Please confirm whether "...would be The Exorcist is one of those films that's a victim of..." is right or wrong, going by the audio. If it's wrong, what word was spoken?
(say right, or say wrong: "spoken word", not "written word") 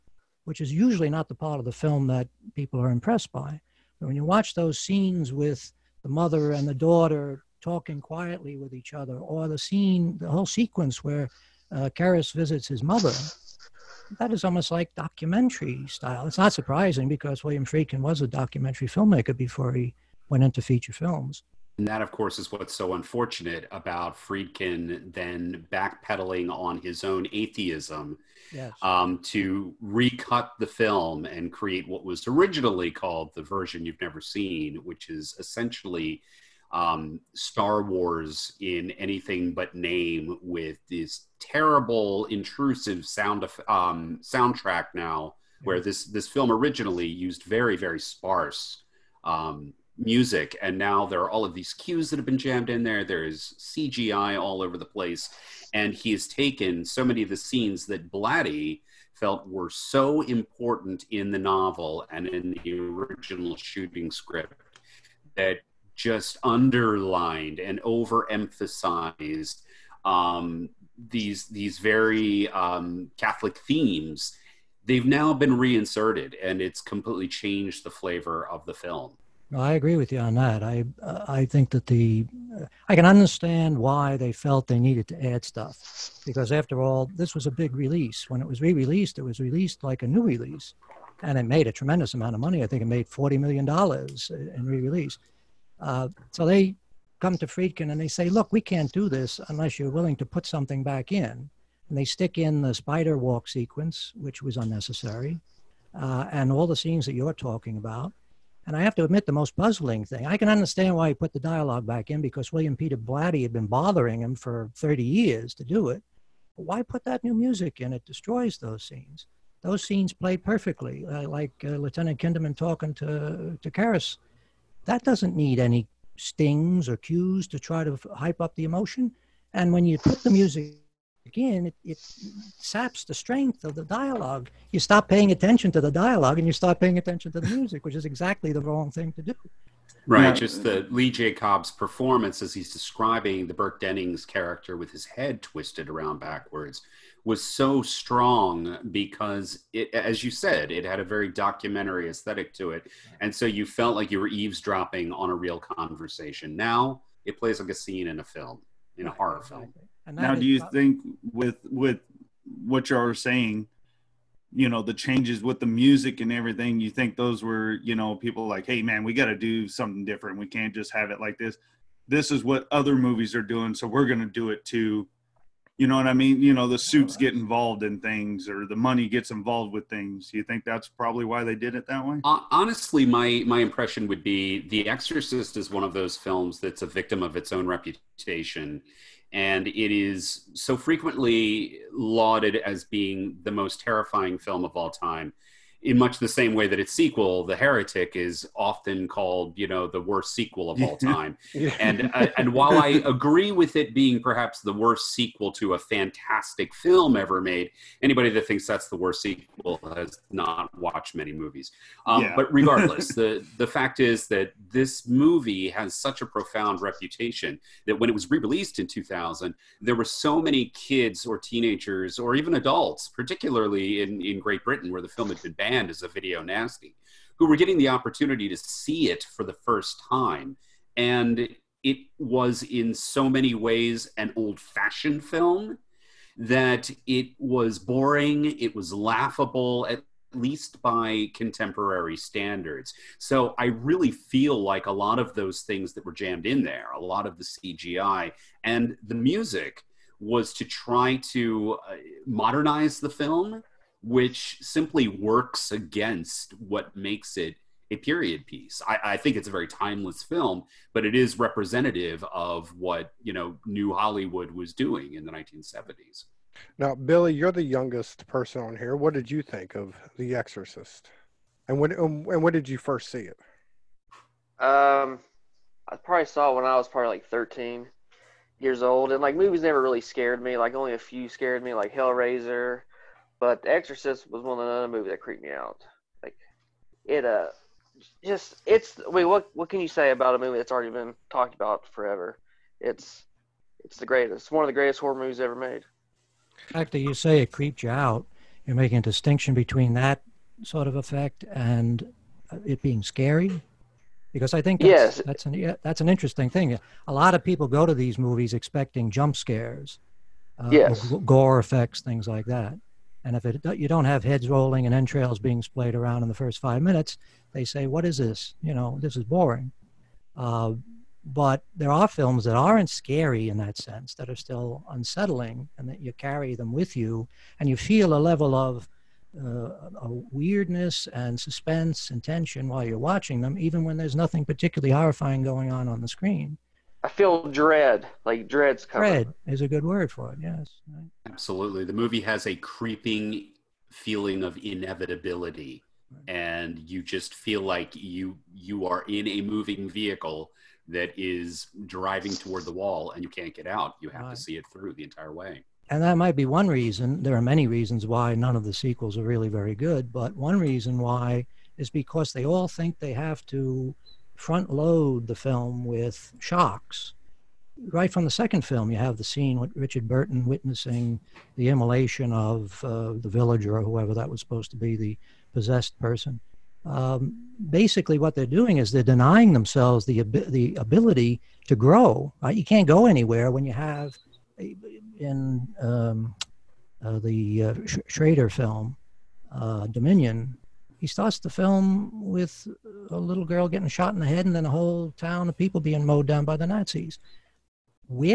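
right.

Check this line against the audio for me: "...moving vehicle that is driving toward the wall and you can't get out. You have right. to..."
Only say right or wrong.
right.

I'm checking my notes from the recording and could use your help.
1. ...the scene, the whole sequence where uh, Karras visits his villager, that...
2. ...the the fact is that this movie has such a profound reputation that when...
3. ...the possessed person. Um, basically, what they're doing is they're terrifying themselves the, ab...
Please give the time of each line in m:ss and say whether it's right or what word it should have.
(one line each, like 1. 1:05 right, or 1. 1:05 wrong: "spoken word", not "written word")
1. 0:09 wrong: "mother", not "villager"
2. 3:33 right
3. 6:14 wrong: "denying", not "terrifying".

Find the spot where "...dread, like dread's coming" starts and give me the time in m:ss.
5:37.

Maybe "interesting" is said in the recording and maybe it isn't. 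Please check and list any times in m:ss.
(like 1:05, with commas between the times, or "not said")
5:06.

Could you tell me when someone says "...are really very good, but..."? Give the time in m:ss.
5:59.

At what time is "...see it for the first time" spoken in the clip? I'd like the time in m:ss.
3:48.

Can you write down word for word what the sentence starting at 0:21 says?
And that, of course, is what's so unfortunate about Friedkin then backpedaling on his own atheism yes.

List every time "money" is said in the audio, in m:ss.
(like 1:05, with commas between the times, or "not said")
1:32, 2:58.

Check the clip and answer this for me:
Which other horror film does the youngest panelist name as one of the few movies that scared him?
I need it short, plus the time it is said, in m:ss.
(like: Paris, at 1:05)
Hellraiser, at 4:41.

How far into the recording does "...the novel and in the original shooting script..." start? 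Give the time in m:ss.
1:01.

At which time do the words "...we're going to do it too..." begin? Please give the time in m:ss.
2:53.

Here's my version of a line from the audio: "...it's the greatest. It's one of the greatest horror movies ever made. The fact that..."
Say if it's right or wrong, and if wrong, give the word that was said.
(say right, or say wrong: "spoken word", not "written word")
right.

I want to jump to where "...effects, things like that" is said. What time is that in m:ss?
5:11.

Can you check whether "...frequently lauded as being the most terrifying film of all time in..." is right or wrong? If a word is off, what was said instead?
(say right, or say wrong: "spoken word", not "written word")
right.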